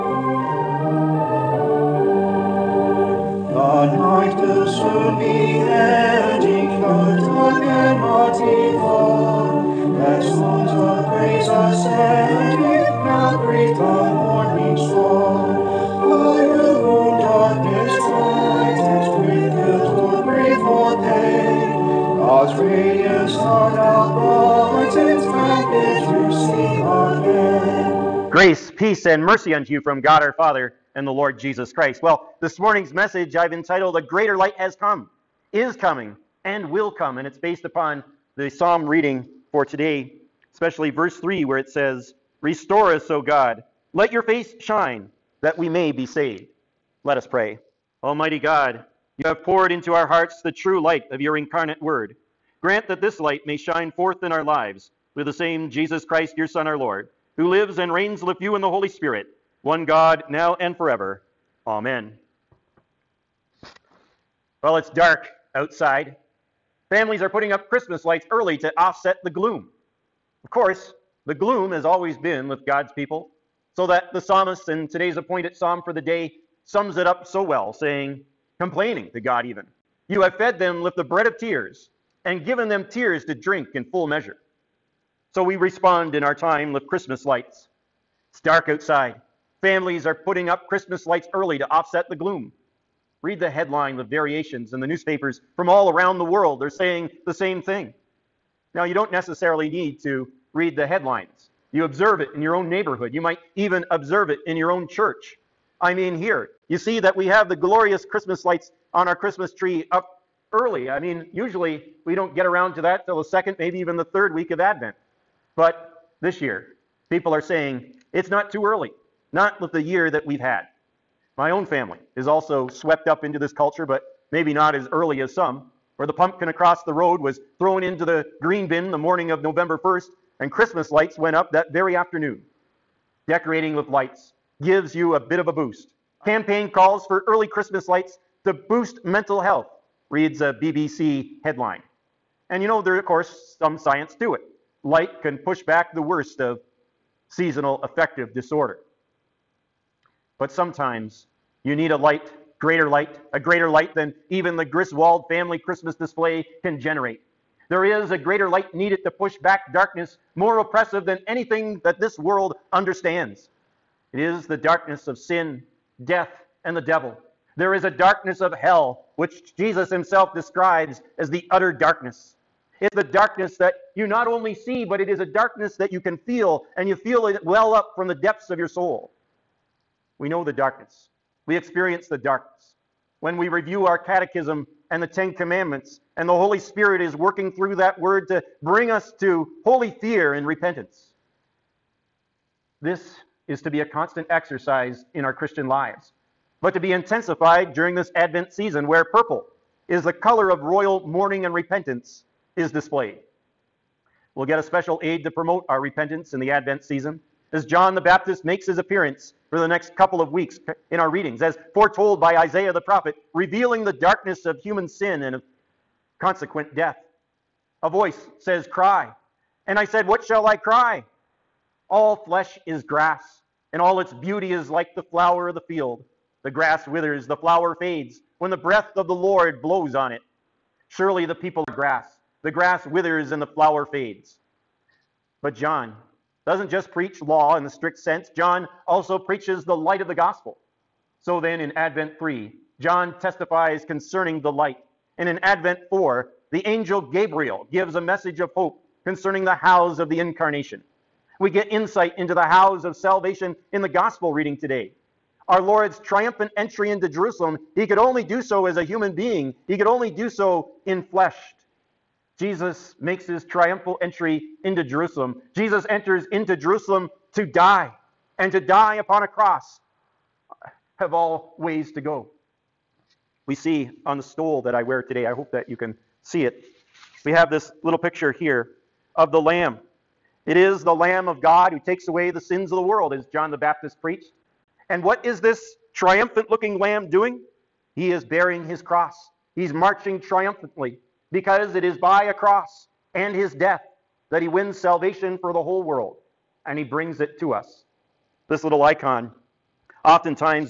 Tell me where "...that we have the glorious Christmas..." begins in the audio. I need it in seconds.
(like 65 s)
106 s.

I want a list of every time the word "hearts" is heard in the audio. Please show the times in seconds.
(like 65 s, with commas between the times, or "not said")
50 s.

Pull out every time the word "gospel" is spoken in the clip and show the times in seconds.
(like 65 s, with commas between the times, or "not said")
240 s, 253 s.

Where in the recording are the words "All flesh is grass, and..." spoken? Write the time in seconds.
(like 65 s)
221 s.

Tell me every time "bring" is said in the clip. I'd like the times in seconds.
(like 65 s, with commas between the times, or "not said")
188 s, 296 s.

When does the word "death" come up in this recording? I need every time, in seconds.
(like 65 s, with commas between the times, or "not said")
166 s, 216 s, 293 s.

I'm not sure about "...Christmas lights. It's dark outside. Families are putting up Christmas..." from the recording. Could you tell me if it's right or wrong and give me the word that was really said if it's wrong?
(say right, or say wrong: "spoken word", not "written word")
right.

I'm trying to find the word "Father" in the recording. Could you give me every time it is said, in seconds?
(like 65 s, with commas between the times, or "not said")
30 s.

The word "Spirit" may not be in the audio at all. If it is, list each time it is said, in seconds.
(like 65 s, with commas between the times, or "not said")
58 s, 186 s.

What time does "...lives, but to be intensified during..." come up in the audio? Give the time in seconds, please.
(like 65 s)
195 s.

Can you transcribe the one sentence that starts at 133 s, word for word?
Decorating with lights gives you a bit of a boost.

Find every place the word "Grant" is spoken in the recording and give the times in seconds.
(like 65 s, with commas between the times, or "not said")
52 s.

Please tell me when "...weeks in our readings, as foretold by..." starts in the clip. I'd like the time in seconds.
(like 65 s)
210 s.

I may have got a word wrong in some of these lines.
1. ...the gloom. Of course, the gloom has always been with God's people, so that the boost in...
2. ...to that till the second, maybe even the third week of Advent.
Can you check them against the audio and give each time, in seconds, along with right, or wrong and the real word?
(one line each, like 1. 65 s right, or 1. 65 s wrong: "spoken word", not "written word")
1. 69 s wrong: "psalmist", not "boost"
2. 112 s right.